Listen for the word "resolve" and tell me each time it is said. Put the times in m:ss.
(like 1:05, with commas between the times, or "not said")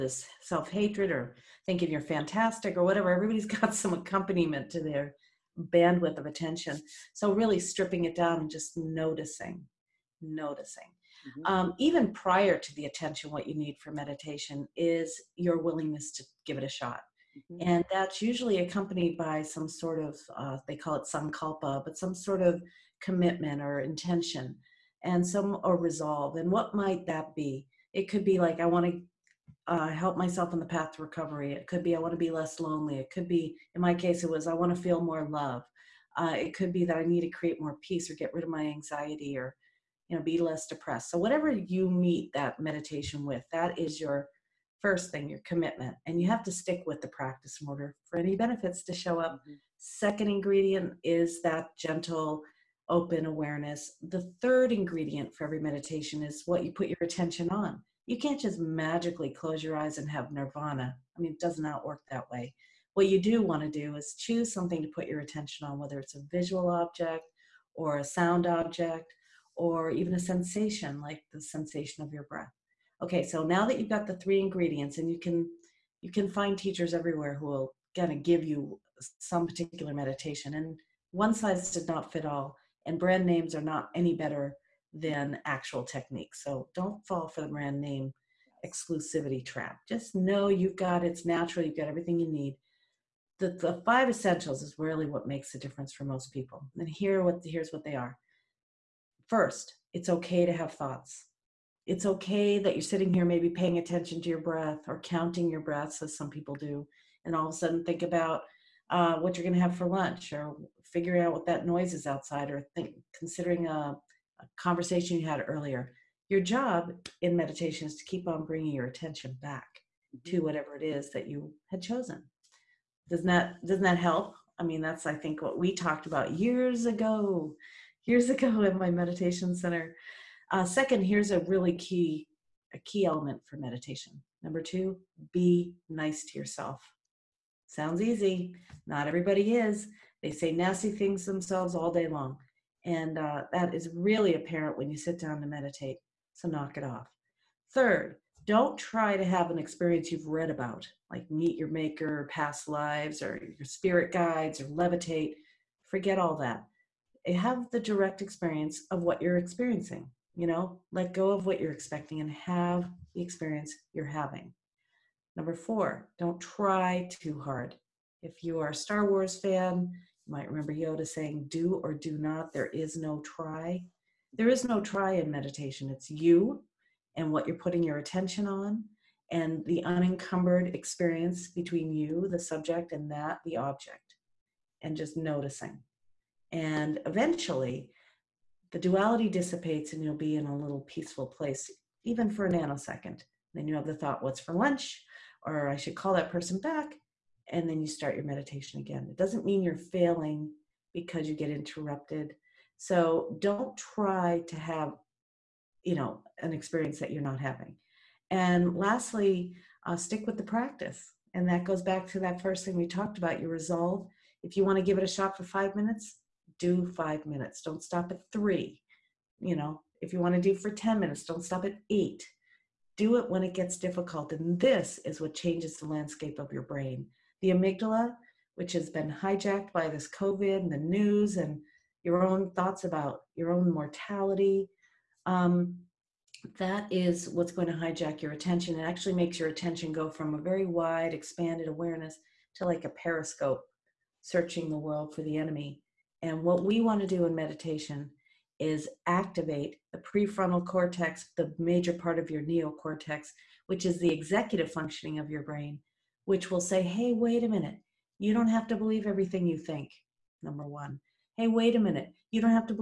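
0:25, 3:33.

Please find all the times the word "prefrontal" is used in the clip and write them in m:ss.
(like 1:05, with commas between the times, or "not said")
4:09.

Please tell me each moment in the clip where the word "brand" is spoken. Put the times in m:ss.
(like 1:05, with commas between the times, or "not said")
1:22, 1:27.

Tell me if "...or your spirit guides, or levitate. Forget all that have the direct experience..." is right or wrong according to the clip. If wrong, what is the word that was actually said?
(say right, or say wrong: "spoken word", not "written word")
right.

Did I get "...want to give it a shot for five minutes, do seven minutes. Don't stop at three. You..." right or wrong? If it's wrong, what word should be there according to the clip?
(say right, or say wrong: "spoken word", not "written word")
wrong: "five", not "seven".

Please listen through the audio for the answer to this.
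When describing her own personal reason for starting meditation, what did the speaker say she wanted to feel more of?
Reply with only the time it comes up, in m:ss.
0:35.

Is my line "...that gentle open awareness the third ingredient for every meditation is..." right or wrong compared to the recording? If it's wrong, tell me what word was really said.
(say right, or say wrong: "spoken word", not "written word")
right.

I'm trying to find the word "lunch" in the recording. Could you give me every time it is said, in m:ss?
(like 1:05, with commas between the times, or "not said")
1:49, 3:14.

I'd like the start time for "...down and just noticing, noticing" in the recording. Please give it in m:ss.
0:08.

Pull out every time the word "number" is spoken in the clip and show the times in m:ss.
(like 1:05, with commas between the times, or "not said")
2:14, 2:45, 4:20.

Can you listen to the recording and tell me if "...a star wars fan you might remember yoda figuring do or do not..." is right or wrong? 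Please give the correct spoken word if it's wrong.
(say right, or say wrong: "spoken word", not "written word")
wrong: "saying", not "figuring".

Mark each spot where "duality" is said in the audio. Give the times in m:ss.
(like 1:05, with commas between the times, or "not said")
3:08.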